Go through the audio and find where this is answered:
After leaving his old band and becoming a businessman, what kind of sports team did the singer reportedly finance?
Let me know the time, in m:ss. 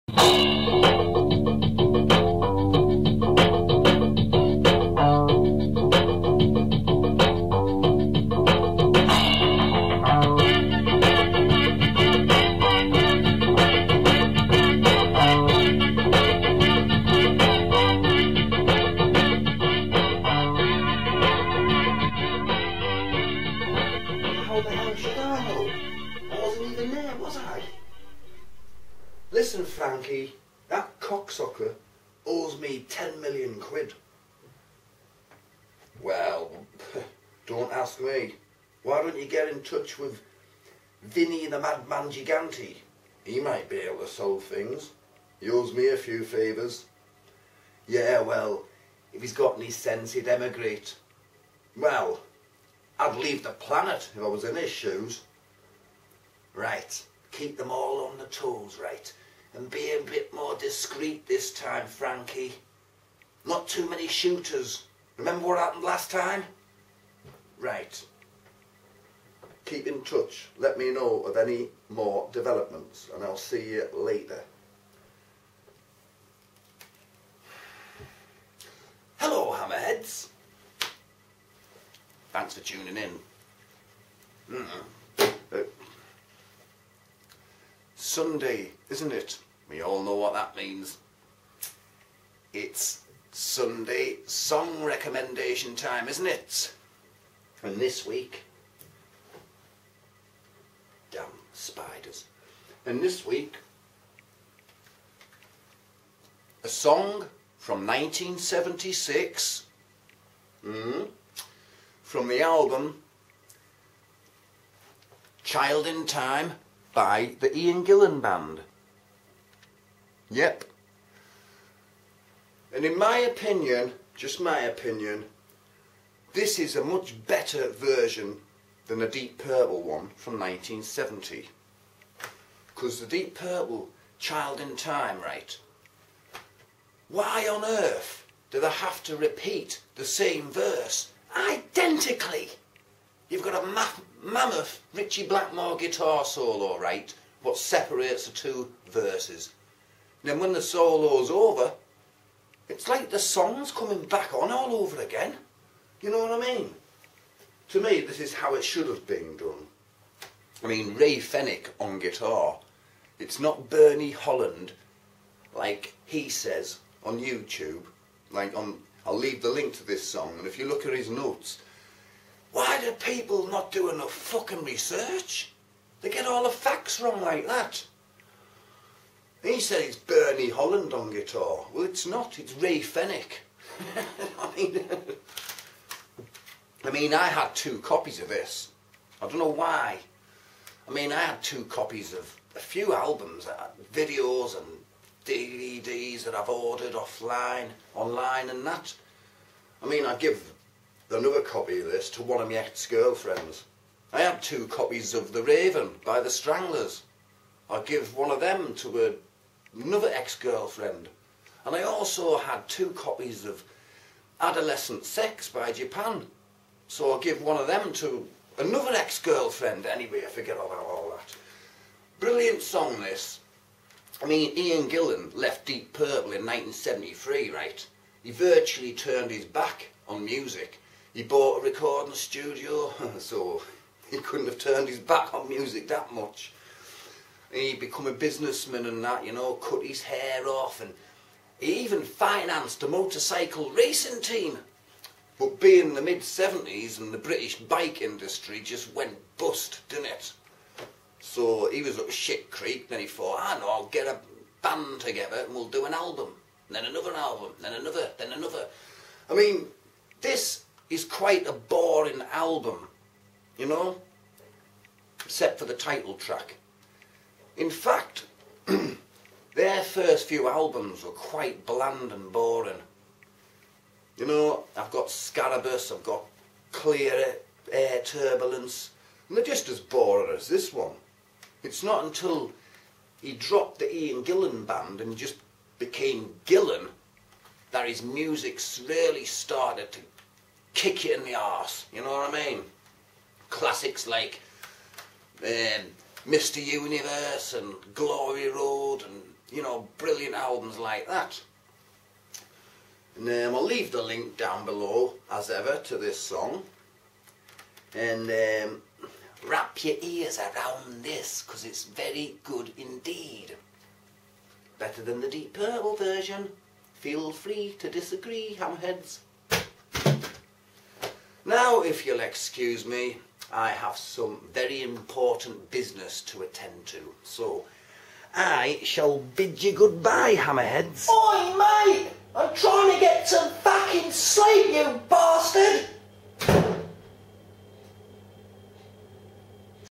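4:02.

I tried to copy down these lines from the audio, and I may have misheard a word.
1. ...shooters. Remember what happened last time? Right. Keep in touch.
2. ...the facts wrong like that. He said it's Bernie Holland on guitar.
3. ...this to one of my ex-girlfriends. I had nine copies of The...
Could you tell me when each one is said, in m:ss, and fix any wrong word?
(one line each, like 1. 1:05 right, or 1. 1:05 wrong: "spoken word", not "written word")
1. 1:04 right
2. 2:56 right
3. 3:21 wrong: "two", not "nine".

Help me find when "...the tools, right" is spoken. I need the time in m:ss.
0:58.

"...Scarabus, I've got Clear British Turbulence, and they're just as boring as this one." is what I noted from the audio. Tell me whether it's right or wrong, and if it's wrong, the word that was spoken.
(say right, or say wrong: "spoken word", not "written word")
wrong: "Air", not "British".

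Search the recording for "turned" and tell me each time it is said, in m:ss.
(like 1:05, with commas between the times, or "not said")
3:48, 3:54.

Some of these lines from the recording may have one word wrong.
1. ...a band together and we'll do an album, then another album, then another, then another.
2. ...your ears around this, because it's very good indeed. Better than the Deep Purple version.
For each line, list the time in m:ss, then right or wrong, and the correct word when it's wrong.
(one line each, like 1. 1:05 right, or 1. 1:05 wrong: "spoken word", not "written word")
1. 4:14 right
2. 5:09 right.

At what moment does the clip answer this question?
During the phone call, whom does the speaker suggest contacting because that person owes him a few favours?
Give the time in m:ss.
0:41.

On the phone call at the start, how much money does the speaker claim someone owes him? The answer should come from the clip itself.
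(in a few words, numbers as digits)
10 million quid.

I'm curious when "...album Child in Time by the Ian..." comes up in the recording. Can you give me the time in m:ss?
1:52.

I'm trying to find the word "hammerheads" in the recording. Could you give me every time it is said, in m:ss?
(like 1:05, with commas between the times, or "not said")
1:19, 5:30.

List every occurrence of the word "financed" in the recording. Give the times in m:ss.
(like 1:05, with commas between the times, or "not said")
4:02.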